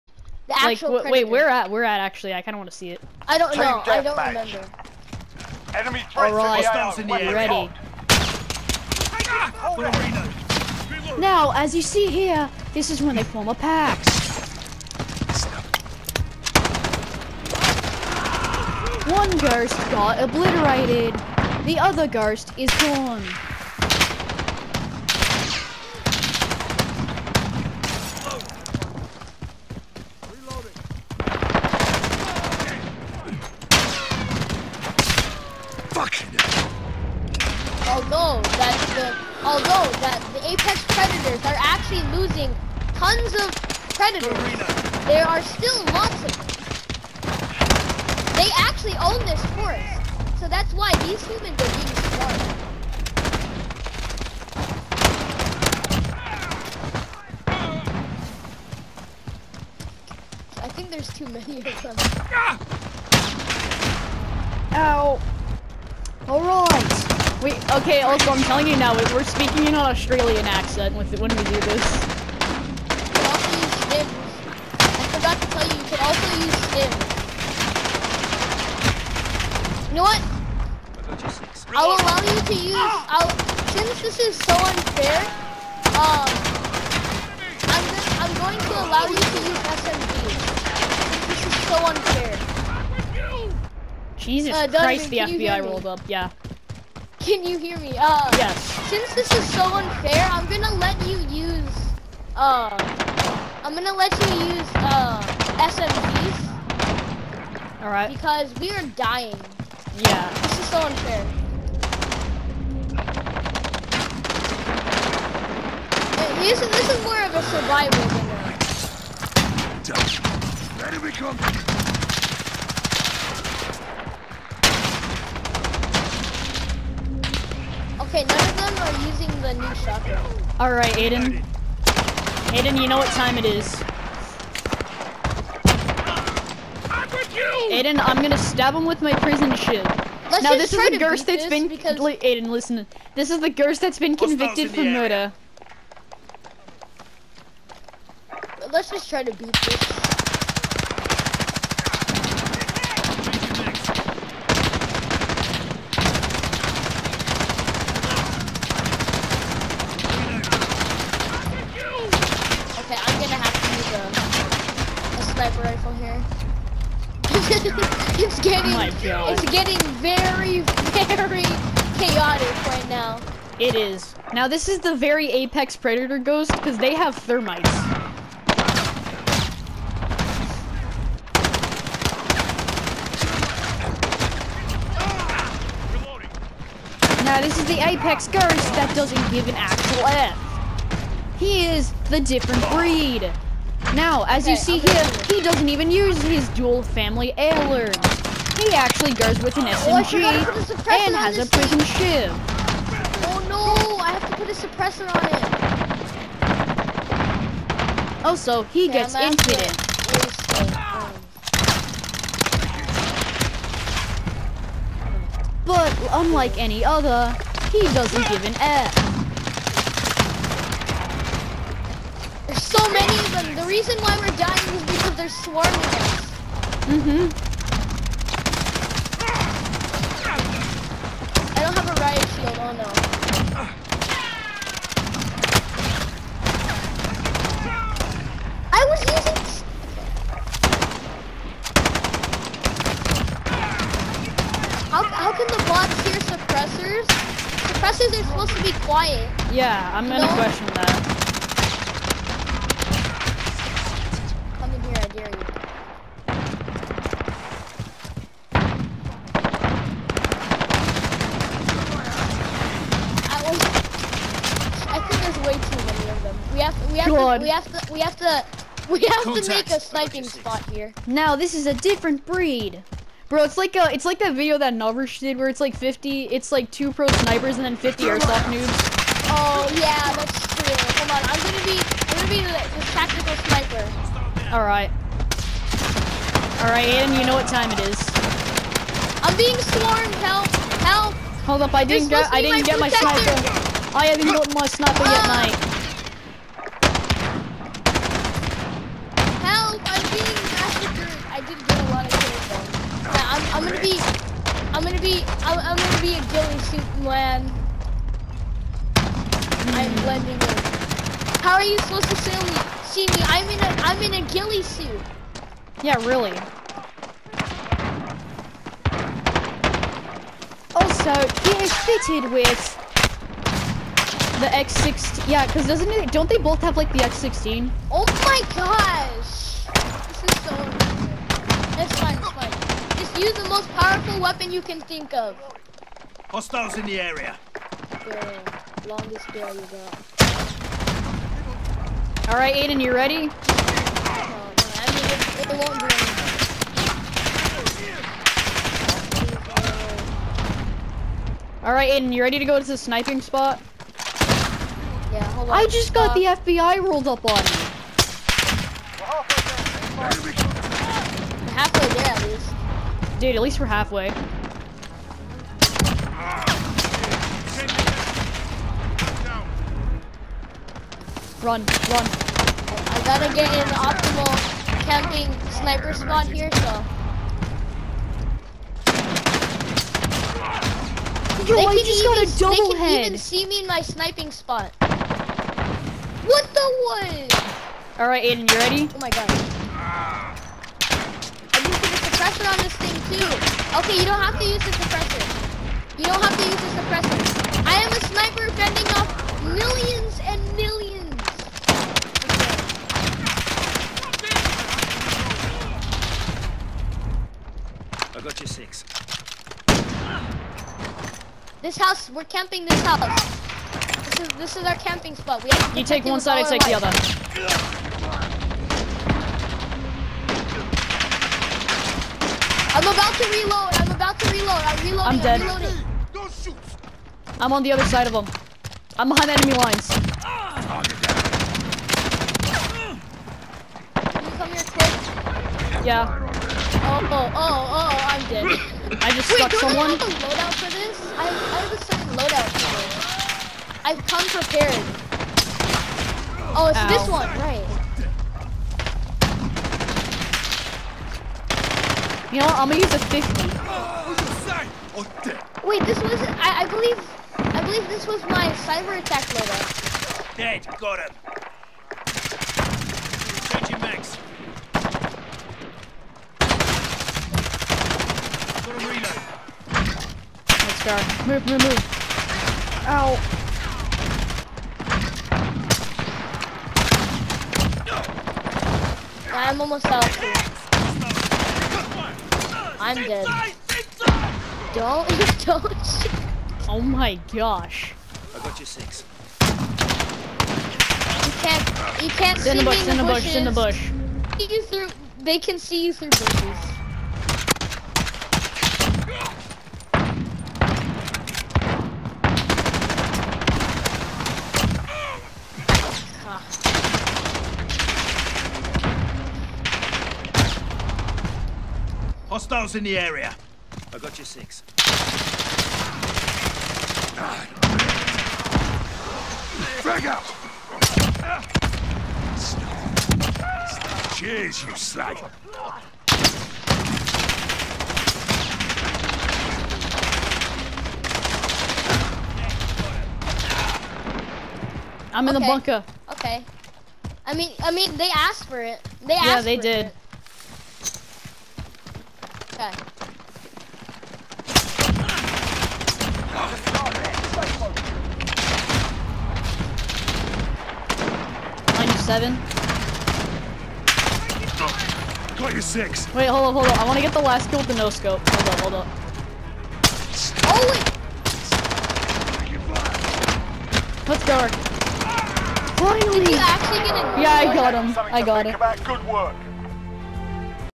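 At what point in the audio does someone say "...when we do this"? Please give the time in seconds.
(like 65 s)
71 s.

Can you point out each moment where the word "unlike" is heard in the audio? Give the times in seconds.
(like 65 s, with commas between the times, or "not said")
216 s.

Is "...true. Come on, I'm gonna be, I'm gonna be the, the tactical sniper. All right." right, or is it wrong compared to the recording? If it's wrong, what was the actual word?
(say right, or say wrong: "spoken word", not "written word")
right.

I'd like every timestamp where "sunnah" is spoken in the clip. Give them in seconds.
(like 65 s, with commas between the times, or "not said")
not said.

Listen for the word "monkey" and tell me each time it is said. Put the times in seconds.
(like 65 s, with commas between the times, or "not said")
not said.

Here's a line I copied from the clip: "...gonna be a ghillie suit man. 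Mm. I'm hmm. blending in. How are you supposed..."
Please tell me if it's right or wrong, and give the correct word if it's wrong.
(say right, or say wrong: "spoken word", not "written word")
right.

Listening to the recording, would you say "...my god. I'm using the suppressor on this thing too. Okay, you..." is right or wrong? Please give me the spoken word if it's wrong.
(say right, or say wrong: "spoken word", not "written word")
right.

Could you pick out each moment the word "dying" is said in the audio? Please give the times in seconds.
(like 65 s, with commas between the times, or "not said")
108 s, 224 s.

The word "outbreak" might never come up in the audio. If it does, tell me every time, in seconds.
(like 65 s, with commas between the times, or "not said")
not said.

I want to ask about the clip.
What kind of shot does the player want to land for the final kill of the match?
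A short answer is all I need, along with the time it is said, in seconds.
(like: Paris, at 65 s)
No scope, at 557 s.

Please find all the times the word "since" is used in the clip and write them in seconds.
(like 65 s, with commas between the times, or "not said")
83 s, 98 s.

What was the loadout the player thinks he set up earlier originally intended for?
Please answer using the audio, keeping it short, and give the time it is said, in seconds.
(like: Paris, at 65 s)
Cyber attack, at 458 s.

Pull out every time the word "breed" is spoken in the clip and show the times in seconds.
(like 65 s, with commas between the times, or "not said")
192 s, 272 s.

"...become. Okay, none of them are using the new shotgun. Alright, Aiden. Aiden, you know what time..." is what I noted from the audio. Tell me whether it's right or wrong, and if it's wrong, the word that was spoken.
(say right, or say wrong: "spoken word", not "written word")
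right.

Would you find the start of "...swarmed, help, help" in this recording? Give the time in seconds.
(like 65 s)
289 s.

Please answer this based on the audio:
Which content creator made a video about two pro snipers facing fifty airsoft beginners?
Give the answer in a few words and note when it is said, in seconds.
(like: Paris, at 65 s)
Novus, at 274 s.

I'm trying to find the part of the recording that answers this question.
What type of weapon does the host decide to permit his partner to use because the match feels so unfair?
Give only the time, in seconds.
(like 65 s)
105 s.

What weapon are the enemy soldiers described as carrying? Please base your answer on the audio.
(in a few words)
X16.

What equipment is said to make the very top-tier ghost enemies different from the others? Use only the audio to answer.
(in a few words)
Thermites.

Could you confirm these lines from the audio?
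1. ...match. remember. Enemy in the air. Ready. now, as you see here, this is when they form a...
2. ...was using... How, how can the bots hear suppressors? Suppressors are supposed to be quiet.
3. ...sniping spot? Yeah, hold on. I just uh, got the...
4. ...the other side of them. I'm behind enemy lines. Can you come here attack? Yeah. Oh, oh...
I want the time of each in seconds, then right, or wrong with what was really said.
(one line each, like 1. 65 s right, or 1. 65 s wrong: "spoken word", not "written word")
1. 4 s right
2. 238 s right
3. 352 s right
4. 427 s wrong: "quick", not "attack".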